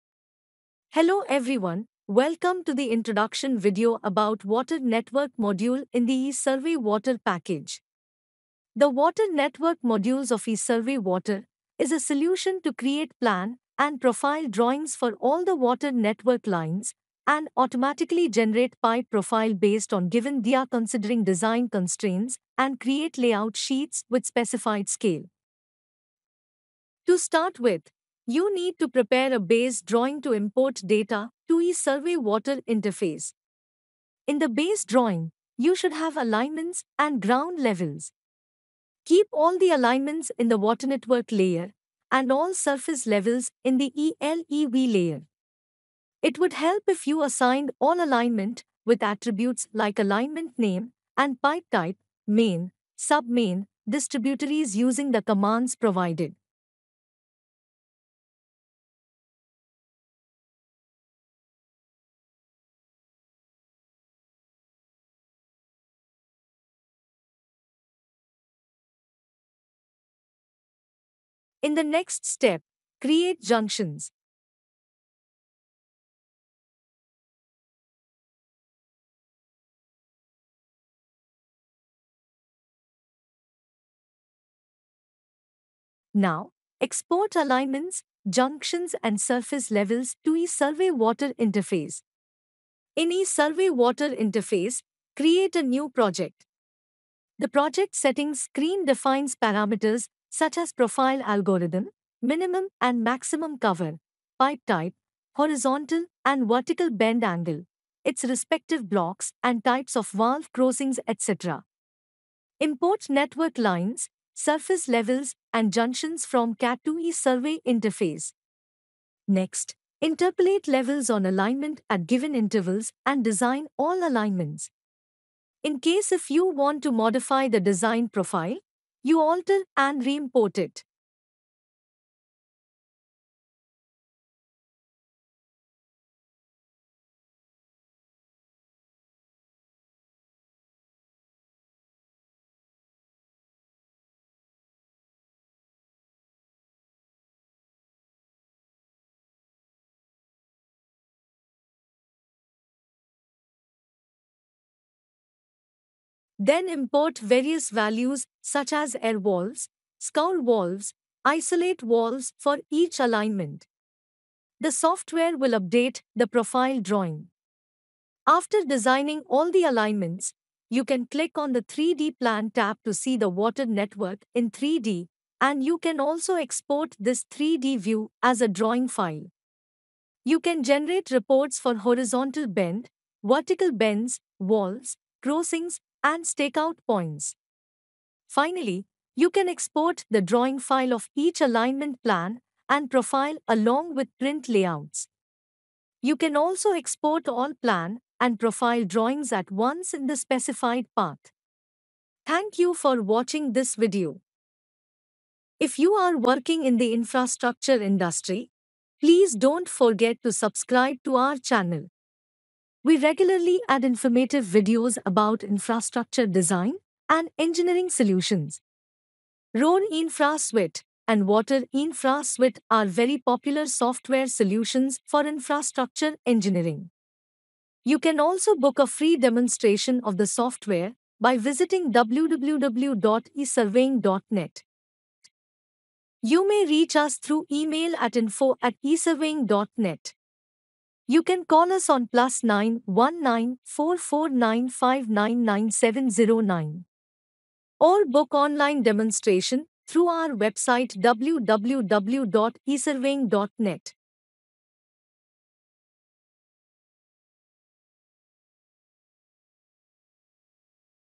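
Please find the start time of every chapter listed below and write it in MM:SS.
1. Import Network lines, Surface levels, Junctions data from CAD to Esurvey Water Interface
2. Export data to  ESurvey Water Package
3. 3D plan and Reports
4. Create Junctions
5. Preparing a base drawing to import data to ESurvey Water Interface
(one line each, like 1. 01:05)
1. 01:52
2. 01:26
3. 02:52
4. 01:11
5. 00:32.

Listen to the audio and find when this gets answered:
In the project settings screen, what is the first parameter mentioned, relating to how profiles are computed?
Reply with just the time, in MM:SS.
01:40.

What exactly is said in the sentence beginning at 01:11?
In the next step, create junctions.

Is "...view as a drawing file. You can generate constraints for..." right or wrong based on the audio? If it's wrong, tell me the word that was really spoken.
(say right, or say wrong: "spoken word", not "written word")
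wrong: "reports", not "constraints".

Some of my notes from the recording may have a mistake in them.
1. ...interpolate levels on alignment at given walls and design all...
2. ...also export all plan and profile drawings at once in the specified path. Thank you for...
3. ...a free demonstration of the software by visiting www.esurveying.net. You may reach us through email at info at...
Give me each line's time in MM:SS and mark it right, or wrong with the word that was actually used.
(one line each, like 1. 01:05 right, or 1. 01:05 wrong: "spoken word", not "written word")
1. 02:00 wrong: "intervals", not "walls"
2. 03:16 right
3. 03:48 right.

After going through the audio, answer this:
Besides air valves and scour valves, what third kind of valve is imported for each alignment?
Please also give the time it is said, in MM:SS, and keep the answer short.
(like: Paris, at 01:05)
Isolate valves, at 02:41.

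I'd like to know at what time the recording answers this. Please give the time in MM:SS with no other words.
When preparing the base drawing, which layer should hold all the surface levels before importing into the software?
00:43.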